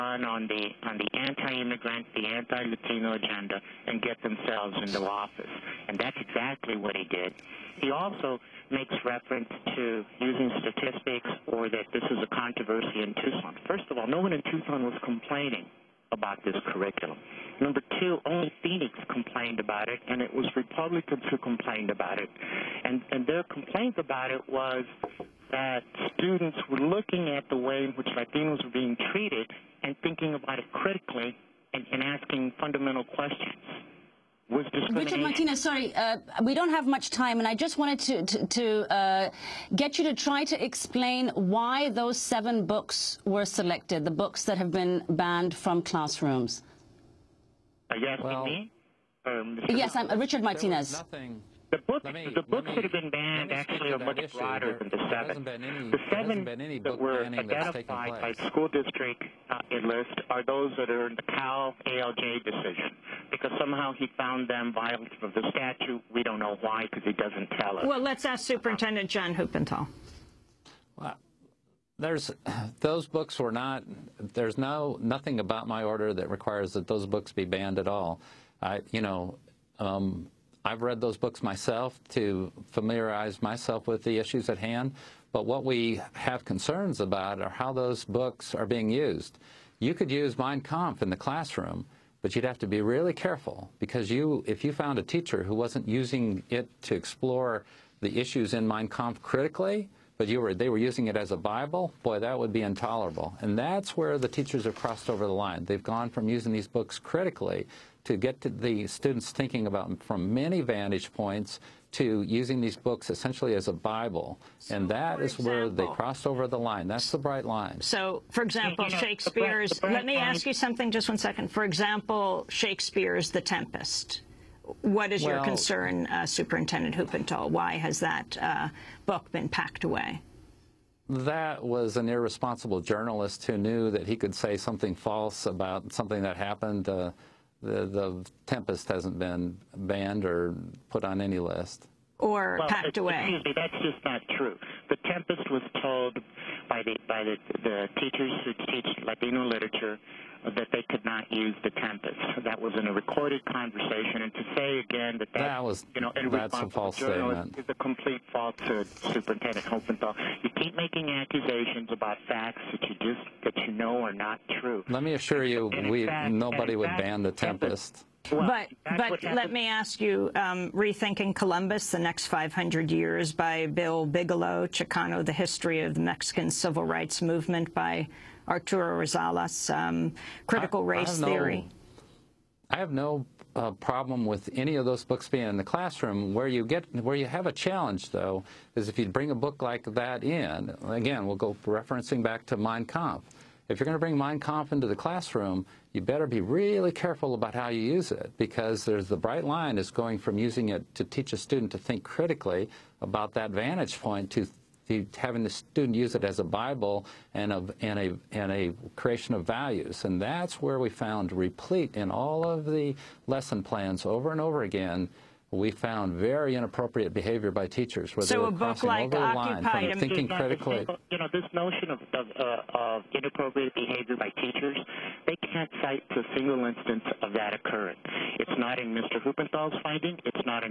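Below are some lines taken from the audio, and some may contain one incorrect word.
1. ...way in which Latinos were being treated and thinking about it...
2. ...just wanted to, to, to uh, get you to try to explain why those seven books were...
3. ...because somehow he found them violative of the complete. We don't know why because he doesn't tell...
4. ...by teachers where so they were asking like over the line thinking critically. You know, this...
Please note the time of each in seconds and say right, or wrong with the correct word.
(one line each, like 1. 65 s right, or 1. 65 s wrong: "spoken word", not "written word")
1. 27 s right
2. 37 s right
3. 63 s wrong: "statute", not "complete"
4. 217 s wrong: "crossing", not "asking".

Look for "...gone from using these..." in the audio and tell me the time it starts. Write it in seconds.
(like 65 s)
105 s.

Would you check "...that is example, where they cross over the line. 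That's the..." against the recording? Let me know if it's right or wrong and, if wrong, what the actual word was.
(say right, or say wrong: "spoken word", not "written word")
right.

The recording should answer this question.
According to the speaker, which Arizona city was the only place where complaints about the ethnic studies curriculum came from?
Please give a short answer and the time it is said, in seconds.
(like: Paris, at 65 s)
Phoenix, at 18 s.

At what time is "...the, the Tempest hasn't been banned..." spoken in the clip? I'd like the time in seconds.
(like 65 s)
137 s.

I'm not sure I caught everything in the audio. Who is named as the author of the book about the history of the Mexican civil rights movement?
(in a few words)
Arturo Rosales.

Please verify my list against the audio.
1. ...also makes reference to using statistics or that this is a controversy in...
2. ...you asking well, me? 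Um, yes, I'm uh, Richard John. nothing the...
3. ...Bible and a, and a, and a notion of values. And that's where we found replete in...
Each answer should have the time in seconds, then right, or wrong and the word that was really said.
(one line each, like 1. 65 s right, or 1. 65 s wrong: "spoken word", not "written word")
1. 7 s right
2. 47 s wrong: "Martinez", not "John"
3. 206 s wrong: "creation", not "notion".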